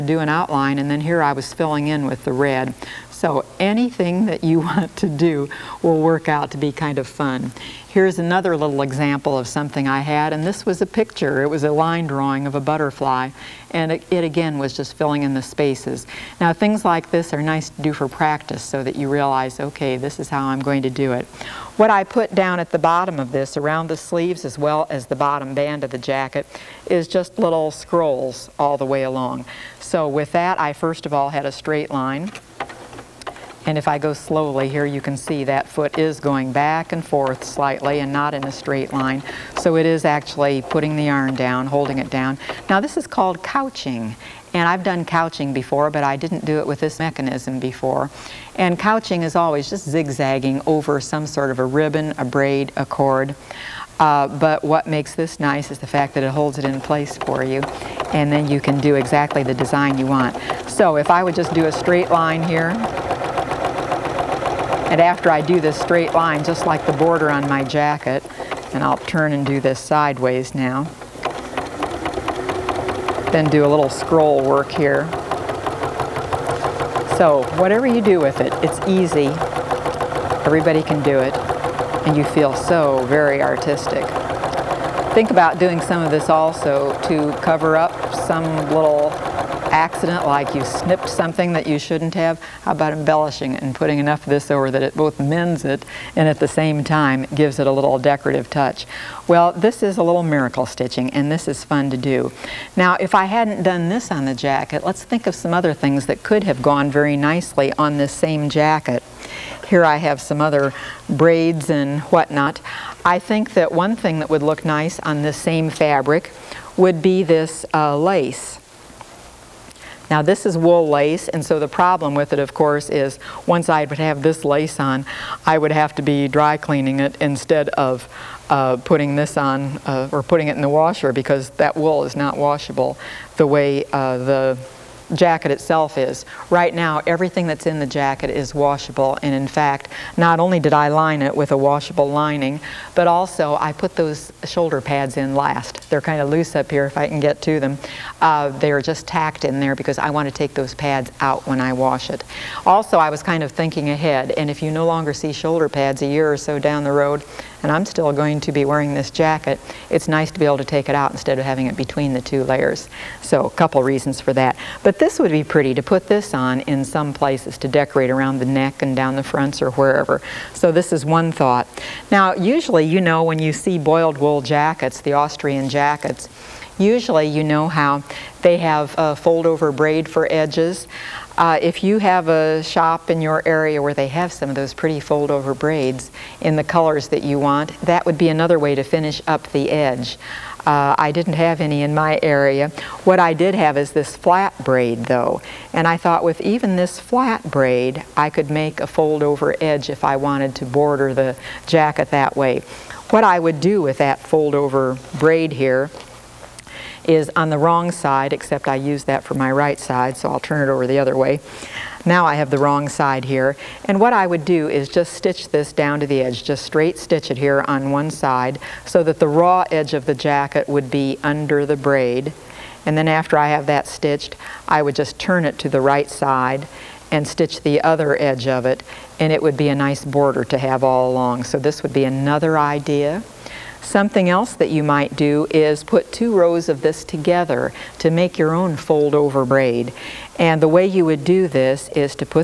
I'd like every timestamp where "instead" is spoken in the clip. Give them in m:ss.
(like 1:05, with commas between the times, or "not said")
2:07, 2:41.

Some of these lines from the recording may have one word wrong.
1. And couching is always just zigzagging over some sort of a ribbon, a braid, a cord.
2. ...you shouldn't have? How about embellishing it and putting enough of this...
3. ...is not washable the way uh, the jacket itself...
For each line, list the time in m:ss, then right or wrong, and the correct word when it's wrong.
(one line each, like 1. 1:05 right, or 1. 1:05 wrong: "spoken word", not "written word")
1. 0:48 right
2. 1:31 right
3. 2:12 right.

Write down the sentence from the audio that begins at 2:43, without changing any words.
So a couple reasons for that.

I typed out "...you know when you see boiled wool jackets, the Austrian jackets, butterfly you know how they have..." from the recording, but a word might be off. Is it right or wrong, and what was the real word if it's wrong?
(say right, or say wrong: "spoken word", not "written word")
wrong: "usually", not "butterfly".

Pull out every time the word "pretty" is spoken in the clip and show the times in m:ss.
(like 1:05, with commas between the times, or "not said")
2:45, 3:04.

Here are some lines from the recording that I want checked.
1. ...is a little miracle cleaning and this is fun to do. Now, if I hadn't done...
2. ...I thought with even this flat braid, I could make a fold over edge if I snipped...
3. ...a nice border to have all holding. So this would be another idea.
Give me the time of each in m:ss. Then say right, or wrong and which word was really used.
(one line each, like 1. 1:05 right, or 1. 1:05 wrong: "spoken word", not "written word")
1. 1:39 wrong: "stitching", not "cleaning"
2. 3:15 wrong: "wanted", not "snipped"
3. 3:49 wrong: "along", not "holding".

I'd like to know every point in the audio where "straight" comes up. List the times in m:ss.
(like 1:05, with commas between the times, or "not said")
0:31, 0:38, 1:01, 1:05, 3:36.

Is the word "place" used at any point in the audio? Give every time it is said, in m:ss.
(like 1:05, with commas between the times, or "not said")
0:56, 2:47.